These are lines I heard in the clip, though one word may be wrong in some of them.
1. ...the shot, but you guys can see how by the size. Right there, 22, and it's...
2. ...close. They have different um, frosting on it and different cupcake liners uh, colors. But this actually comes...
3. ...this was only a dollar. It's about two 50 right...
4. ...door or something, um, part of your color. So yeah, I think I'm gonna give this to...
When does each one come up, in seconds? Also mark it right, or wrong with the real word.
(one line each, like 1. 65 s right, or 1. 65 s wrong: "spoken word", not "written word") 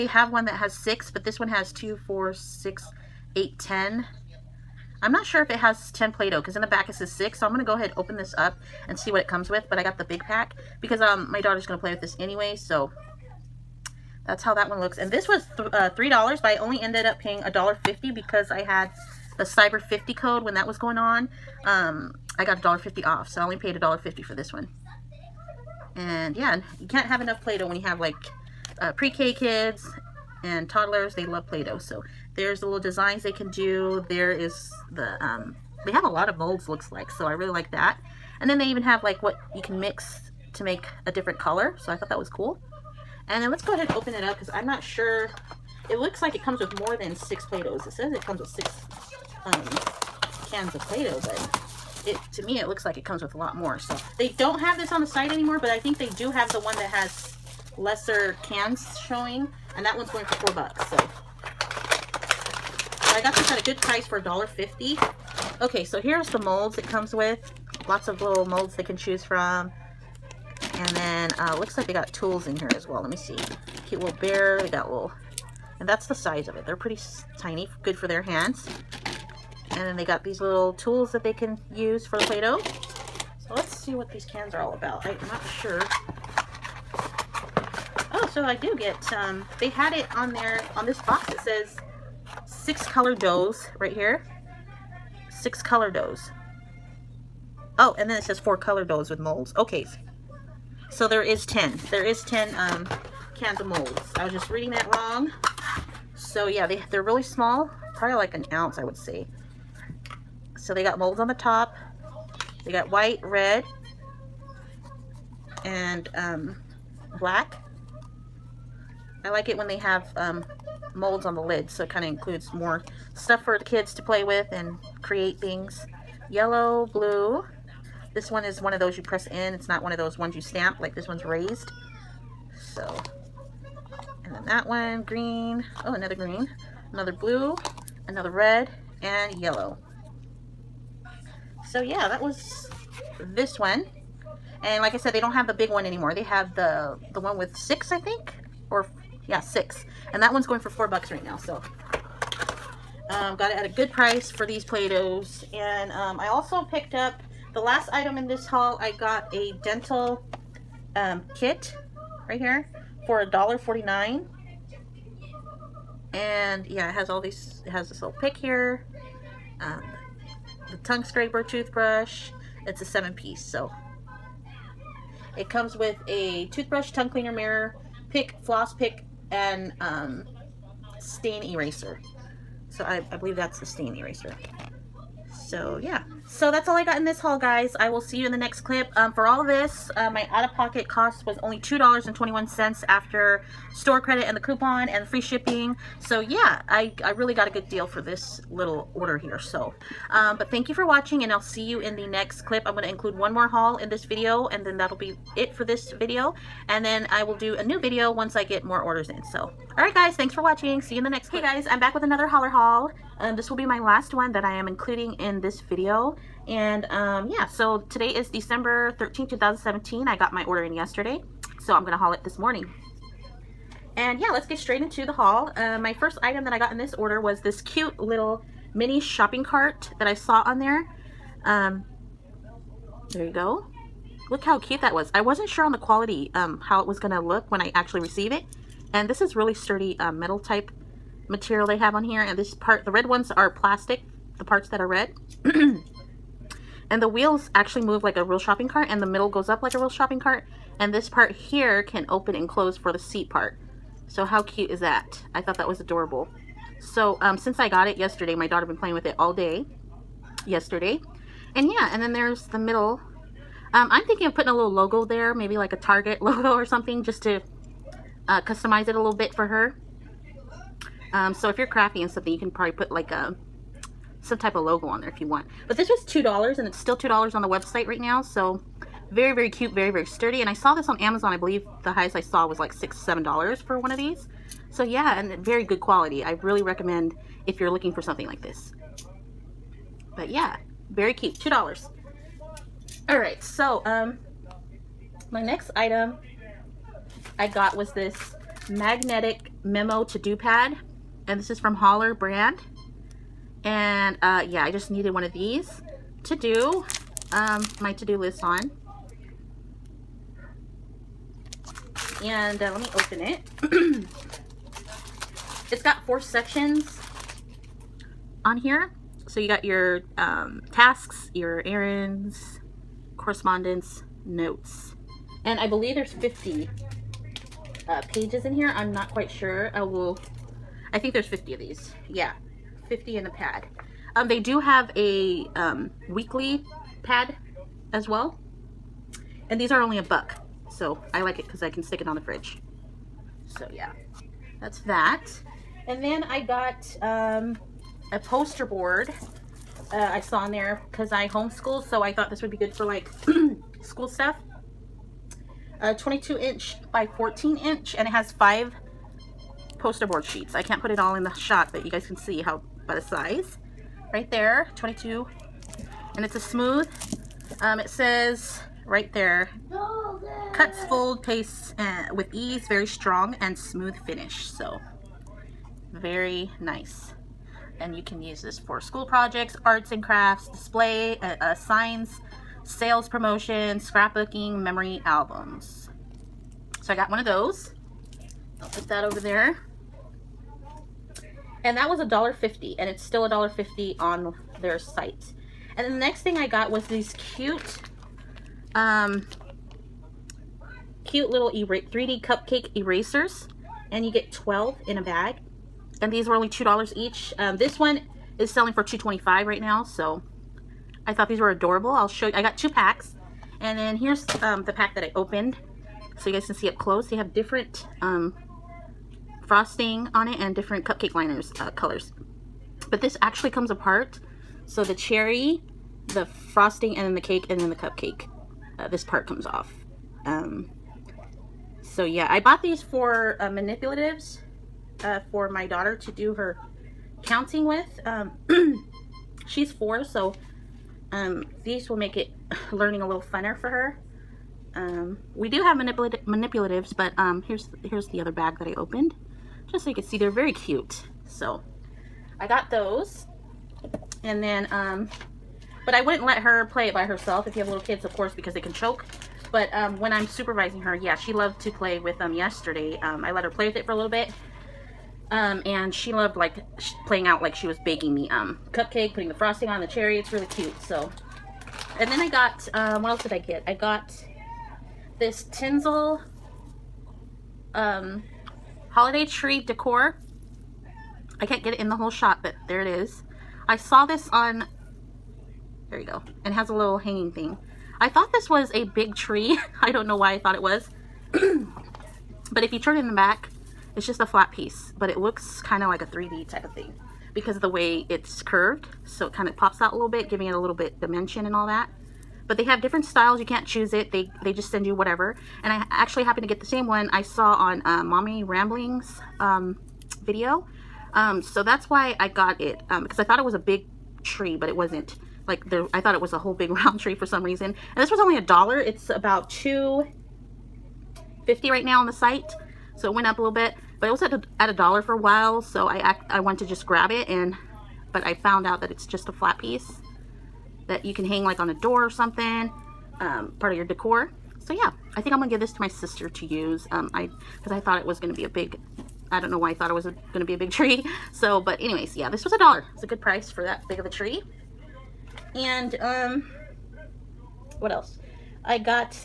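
1. 361 s right
2. 416 s right
3. 518 s right
4. 531 s wrong: "decor", not "color".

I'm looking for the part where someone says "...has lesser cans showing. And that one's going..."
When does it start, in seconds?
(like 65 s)
56 s.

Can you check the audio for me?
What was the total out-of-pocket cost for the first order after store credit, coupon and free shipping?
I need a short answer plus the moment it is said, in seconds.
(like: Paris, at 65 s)
$2.21, at 191 s.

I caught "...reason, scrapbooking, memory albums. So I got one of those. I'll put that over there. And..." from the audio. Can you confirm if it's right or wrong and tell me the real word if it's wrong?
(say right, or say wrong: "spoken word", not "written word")
wrong: "promotion", not "reason".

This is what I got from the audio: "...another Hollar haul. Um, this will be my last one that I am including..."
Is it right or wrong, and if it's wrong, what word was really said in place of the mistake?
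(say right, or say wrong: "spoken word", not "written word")
right.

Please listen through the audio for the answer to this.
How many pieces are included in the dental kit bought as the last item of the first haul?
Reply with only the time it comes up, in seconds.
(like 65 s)
172 s.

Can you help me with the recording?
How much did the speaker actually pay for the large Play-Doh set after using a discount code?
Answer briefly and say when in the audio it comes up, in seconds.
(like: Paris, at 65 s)
$1.50, at 23 s.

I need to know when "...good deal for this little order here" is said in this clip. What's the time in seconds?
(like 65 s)
197 s.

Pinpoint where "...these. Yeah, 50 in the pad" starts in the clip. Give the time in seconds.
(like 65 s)
331 s.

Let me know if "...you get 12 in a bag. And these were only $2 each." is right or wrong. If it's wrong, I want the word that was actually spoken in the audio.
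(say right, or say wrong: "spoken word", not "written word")
right.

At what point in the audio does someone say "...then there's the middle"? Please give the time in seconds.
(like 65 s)
262 s.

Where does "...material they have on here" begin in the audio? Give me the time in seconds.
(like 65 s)
241 s.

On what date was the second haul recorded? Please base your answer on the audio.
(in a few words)
December 13, 2017.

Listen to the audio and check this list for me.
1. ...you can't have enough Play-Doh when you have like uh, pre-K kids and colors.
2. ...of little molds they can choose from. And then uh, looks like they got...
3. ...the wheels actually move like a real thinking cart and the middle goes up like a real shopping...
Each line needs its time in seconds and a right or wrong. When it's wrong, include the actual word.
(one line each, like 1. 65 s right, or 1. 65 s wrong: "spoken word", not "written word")
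1. 26 s wrong: "toddlers", not "colors"
2. 68 s right
3. 247 s wrong: "shopping", not "thinking".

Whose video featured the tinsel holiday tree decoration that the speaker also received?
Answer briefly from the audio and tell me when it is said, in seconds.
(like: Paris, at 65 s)
Mommy Ramblings, at 508 s.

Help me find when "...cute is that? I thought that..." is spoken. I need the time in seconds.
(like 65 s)
254 s.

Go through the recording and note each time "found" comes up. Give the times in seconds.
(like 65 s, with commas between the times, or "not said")
528 s.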